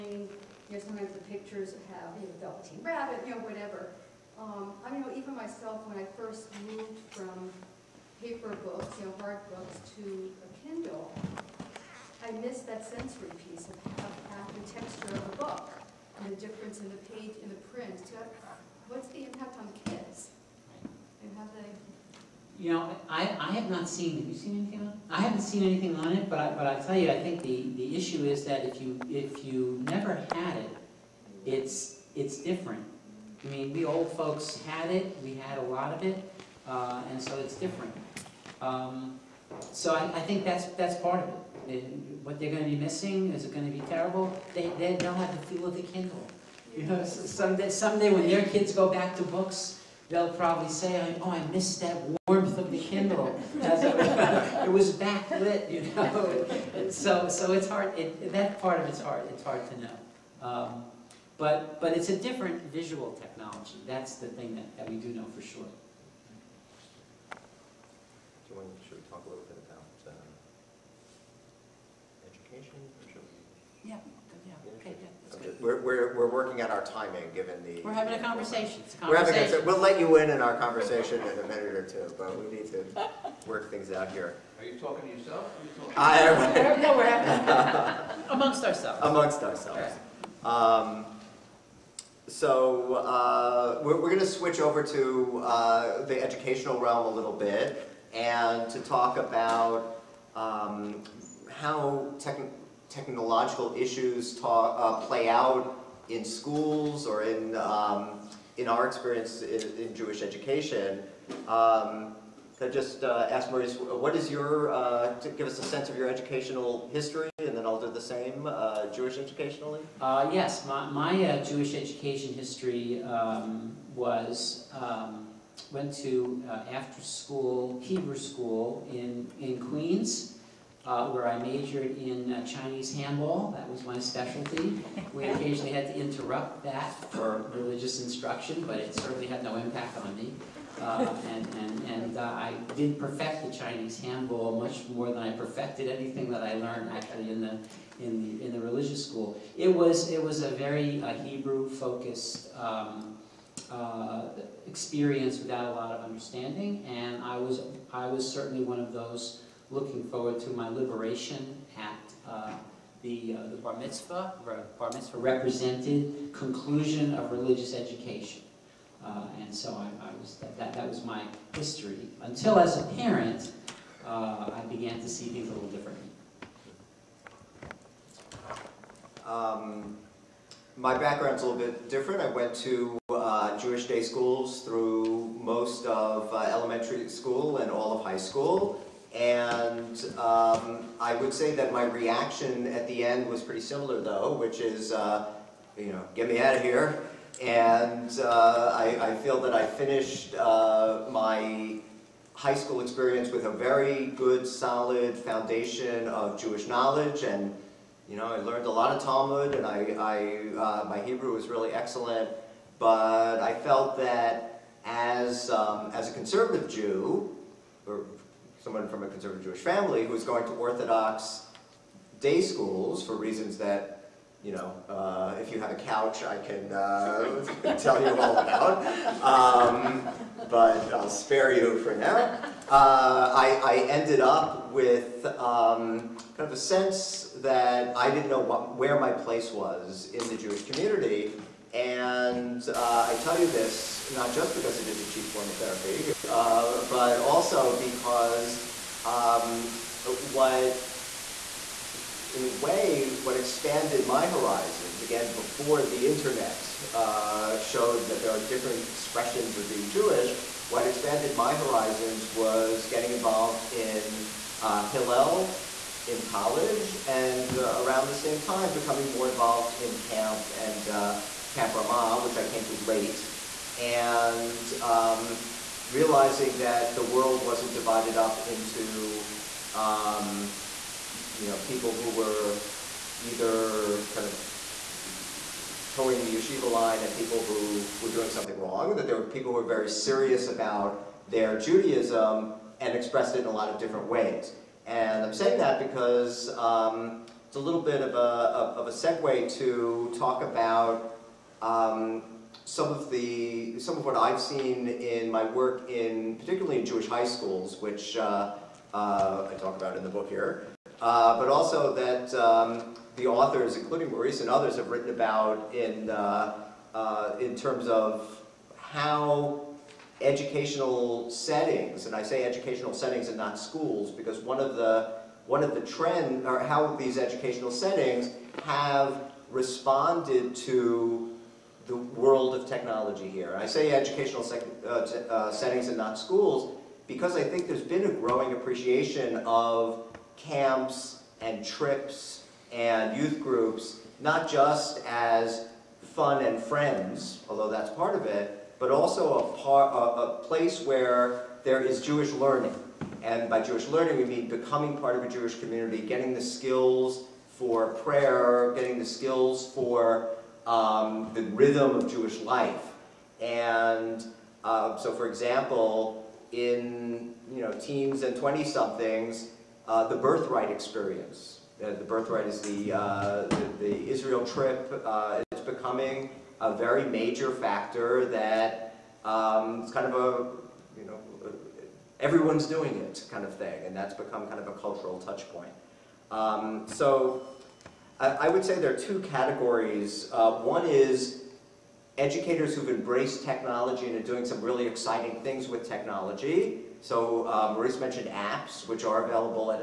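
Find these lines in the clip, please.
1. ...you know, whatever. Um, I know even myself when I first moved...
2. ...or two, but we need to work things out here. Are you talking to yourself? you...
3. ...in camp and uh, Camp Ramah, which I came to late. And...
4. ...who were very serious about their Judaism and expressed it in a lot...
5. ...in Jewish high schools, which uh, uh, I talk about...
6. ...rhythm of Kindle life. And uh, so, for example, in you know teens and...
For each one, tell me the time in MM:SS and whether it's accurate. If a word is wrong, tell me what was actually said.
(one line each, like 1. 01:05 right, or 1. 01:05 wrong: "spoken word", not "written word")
1. 00:03 right
2. 01:21 right
3. 04:29 right
4. 04:49 right
5. 05:06 right
6. 06:01 wrong: "Jewish", not "Kindle".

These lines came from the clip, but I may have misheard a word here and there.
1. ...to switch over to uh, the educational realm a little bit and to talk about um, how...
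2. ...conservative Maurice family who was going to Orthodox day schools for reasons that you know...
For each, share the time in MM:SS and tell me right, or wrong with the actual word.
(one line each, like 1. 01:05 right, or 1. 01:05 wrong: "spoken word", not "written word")
1. 01:34 right
2. 03:39 wrong: "Jewish", not "Maurice".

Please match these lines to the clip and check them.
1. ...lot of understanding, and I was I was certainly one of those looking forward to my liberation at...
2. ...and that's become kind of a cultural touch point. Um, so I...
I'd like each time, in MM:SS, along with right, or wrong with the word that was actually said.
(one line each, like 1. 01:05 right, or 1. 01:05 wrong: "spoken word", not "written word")
1. 02:35 right
2. 06:23 right.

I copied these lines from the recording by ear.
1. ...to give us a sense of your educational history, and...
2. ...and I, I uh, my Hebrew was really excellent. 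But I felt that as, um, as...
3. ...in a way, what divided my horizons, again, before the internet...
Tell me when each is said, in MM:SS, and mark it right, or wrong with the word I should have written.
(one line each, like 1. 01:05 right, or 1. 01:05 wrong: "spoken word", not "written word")
1. 01:55 right
2. 03:29 right
3. 04:12 wrong: "expanded", not "divided".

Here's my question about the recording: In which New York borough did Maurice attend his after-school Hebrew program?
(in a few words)
Queens.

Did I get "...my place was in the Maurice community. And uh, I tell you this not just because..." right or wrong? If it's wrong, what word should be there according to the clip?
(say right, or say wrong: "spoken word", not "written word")
wrong: "Jewish", not "Maurice".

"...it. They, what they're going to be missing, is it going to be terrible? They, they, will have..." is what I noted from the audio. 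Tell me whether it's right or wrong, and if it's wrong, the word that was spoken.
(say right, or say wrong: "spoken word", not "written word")
right.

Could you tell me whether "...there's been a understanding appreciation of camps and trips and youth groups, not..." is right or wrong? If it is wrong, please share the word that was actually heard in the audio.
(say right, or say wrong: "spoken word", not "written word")
wrong: "growing", not "understanding".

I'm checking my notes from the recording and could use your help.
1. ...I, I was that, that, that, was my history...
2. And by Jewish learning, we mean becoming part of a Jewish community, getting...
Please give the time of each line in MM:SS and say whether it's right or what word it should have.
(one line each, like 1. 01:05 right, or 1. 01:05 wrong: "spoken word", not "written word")
1. 02:49 right
2. 05:53 right.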